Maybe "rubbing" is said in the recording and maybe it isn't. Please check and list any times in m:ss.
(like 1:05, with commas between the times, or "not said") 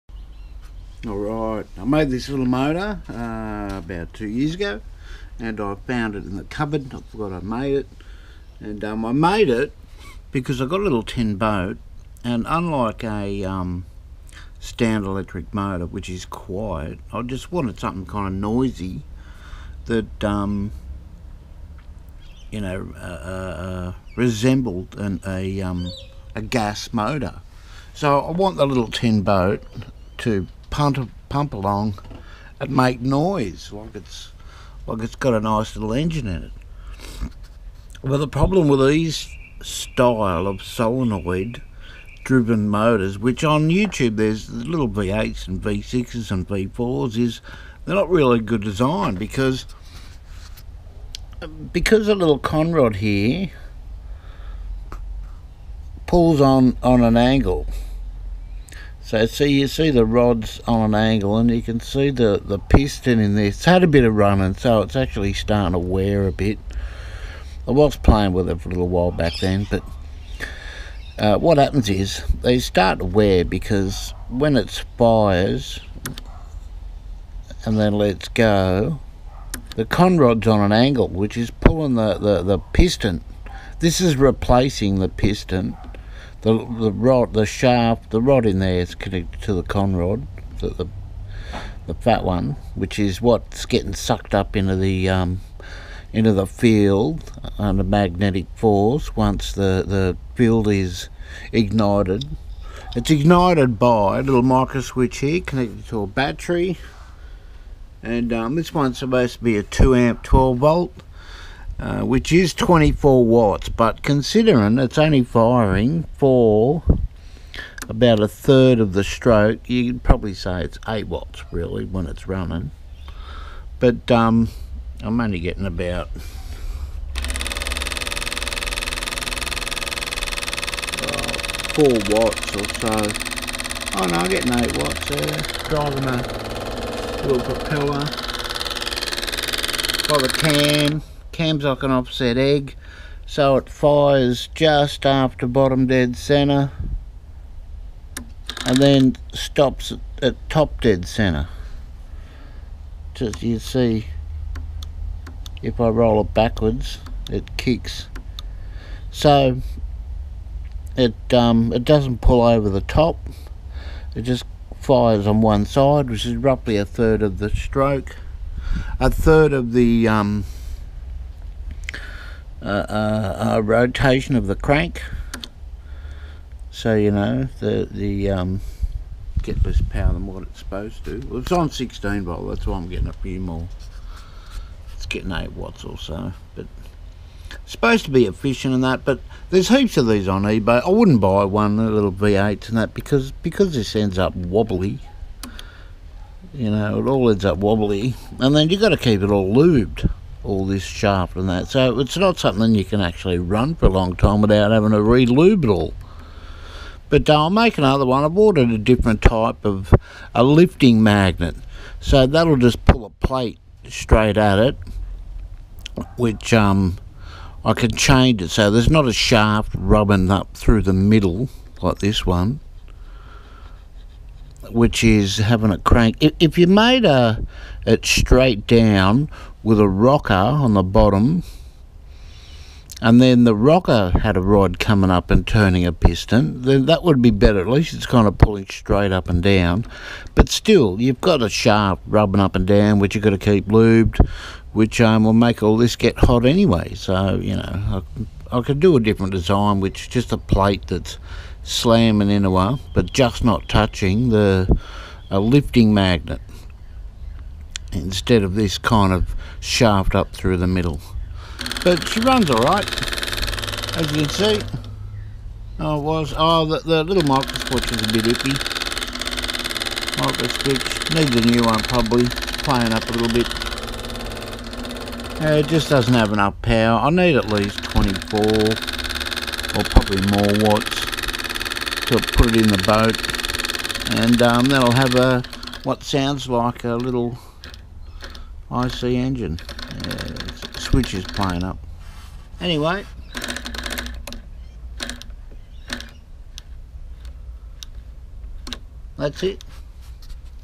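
3:39, 4:02.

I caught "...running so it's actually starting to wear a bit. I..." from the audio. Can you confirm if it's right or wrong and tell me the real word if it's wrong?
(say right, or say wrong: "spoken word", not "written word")
right.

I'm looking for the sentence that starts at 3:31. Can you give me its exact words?
So that'll just pull a plate straight at it, which um, I can change it.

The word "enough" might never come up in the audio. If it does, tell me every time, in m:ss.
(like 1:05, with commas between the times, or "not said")
4:36.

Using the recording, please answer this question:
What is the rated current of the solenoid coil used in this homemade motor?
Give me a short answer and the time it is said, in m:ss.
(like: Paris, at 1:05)
2 amps, at 1:49.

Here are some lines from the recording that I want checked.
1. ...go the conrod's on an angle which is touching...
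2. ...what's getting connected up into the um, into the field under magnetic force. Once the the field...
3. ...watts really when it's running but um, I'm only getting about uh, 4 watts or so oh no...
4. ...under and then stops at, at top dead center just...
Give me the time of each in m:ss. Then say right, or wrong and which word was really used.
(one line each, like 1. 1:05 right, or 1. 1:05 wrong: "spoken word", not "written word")
1. 1:18 wrong: "pulling", not "touching"
2. 1:33 wrong: "sucked", not "connected"
3. 2:01 right
4. 2:26 wrong: "center", not "under".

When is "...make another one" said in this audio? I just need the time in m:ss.
3:27.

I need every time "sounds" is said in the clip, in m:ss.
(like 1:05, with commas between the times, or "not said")
4:46.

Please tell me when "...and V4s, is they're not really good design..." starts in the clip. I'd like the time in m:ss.
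0:46.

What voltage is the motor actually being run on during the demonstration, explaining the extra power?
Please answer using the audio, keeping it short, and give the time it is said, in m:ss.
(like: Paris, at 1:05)
16 volts, at 3:01.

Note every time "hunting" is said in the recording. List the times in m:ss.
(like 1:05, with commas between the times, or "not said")
not said.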